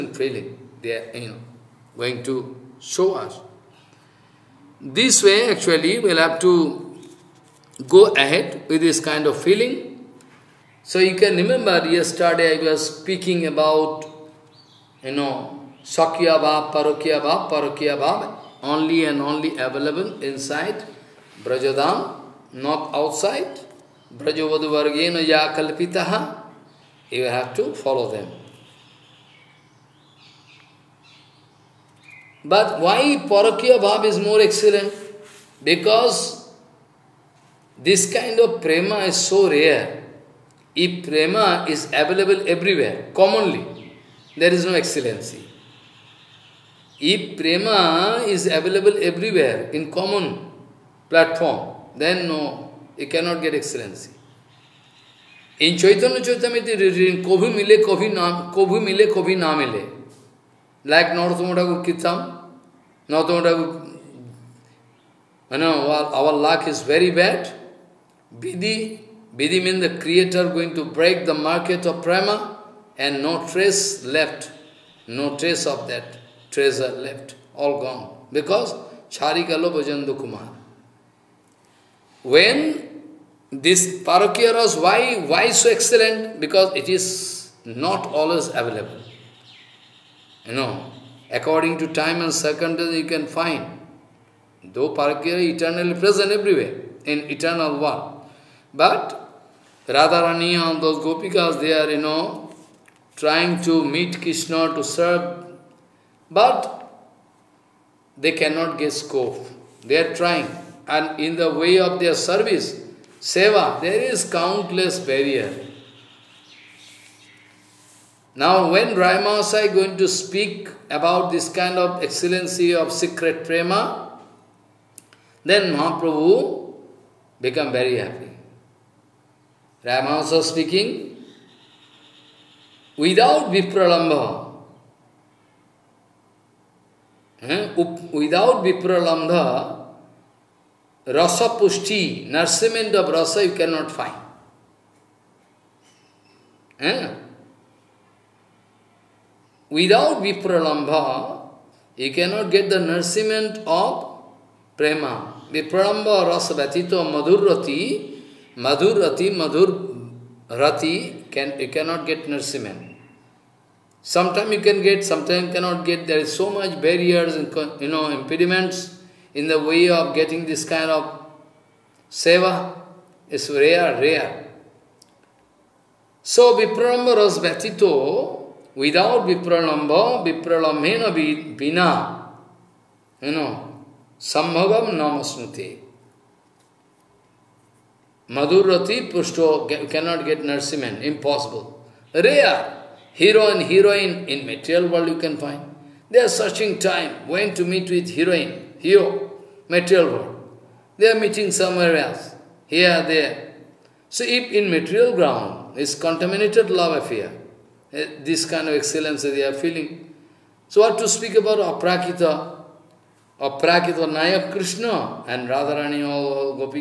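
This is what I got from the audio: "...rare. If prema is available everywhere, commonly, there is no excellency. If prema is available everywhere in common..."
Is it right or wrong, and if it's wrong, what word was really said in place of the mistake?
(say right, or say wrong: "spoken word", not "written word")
right.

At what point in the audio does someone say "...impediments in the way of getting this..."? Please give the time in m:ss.
2:48.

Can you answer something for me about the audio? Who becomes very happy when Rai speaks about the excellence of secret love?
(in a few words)
Mahaprabhu.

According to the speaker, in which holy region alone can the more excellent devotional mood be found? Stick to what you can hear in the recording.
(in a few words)
Brajadam.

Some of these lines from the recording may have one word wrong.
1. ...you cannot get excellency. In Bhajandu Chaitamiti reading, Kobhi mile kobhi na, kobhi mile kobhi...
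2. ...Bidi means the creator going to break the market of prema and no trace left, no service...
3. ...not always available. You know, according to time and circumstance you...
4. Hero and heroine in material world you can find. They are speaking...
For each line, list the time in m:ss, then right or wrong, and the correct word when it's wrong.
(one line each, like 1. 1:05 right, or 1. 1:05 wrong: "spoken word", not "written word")
1. 0:52 wrong: "Chaitanya", not "Bhajandu"
2. 1:09 wrong: "trace", not "service"
3. 1:27 right
4. 3:13 wrong: "searching", not "speaking".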